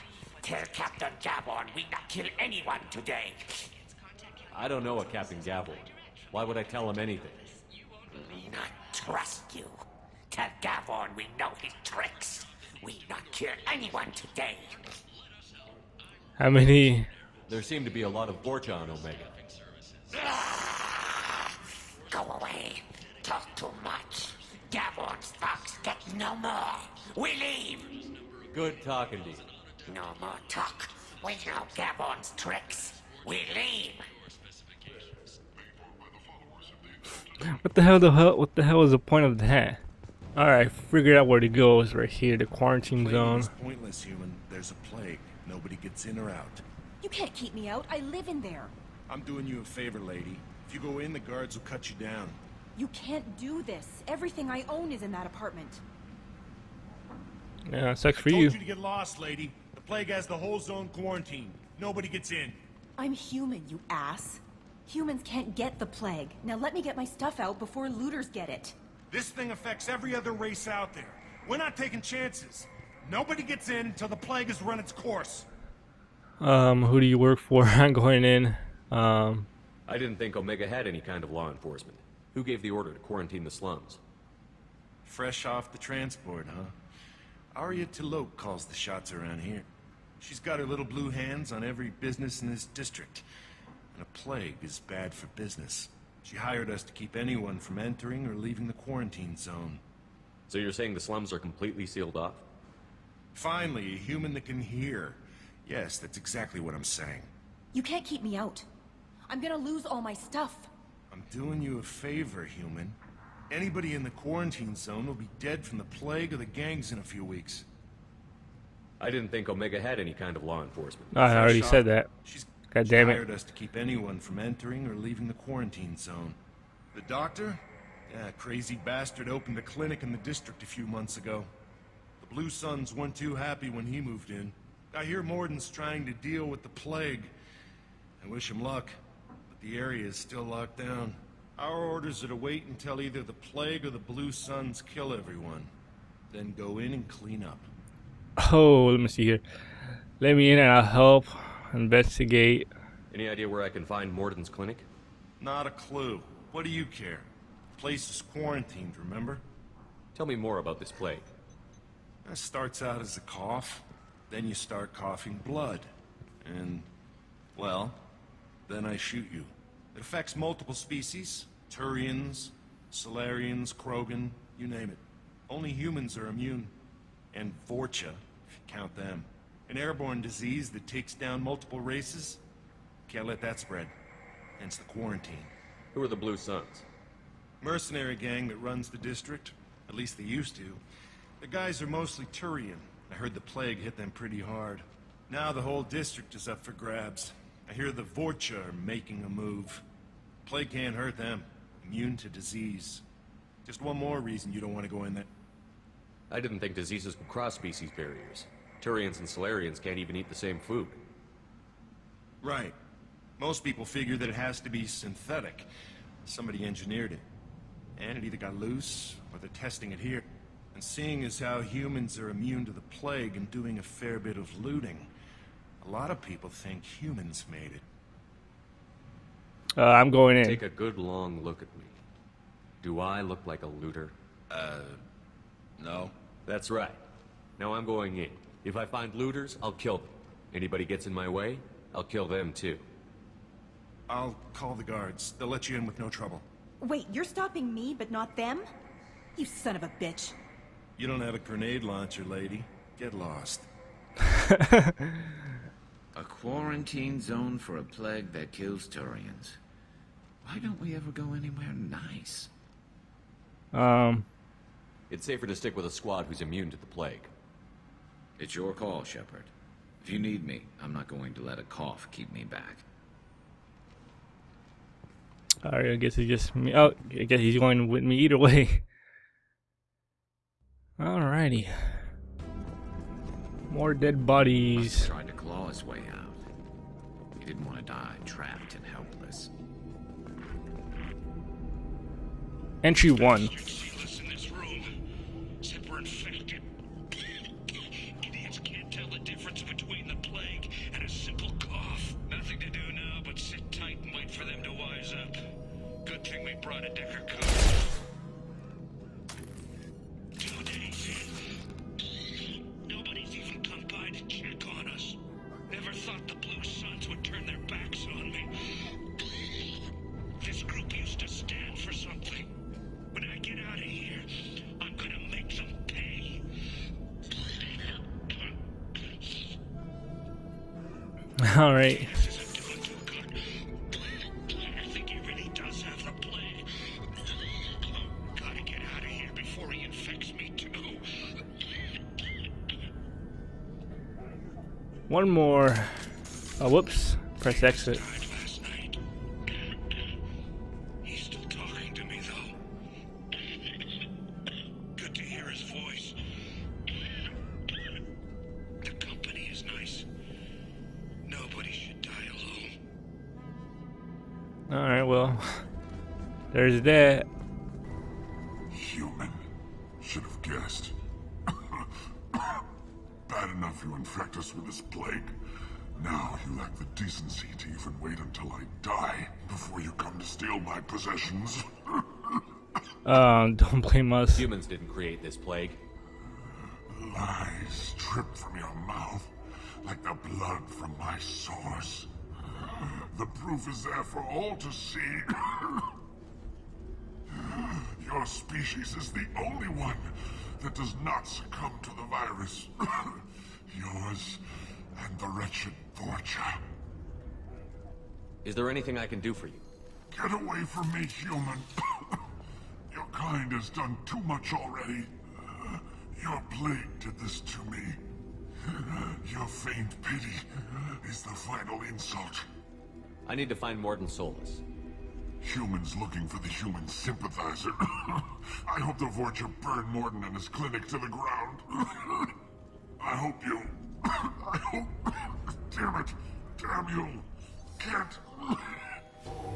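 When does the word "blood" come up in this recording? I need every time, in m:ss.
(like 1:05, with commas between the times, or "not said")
2:45, 6:30.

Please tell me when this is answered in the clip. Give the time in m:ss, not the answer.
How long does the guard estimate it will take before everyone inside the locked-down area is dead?
1:56.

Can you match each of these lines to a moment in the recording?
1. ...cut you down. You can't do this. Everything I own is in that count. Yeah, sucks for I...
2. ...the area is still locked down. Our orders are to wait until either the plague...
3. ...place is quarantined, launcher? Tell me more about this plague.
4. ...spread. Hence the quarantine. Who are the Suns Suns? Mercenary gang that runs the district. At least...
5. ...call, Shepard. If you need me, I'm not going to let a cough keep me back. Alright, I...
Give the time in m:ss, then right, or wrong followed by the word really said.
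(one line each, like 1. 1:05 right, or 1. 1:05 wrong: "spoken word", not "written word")
1. 0:51 wrong: "apartment", not "count"
2. 2:19 right
3. 2:37 wrong: "remember", not "launcher"
4. 3:03 wrong: "Blue", not "Suns"
5. 4:28 right.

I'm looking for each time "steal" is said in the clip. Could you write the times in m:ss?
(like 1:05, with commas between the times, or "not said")
6:20.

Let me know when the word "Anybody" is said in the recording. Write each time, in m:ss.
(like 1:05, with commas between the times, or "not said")
1:53, 4:00.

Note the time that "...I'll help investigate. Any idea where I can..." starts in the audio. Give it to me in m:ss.
2:30.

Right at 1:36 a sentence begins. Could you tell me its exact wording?
She hired us to keep anyone from entering or leaving the quarantine zone.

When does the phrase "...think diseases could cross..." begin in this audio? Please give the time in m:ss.
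3:26.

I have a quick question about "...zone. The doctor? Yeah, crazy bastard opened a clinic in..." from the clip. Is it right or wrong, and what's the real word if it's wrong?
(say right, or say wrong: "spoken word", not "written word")
right.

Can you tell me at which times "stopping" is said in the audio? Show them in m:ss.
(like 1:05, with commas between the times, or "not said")
4:07.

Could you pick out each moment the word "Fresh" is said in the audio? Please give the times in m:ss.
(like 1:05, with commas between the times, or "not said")
1:25.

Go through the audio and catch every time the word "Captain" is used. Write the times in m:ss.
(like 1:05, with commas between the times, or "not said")
0:00, 0:05.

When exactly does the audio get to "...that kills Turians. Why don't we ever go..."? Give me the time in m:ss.
4:18.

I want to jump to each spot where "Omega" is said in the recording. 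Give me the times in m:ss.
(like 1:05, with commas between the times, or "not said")
0:18, 1:20, 1:59.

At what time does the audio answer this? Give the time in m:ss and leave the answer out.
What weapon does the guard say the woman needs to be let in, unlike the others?
4:11.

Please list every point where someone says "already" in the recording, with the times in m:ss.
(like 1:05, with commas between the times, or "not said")
2:01, 6:54.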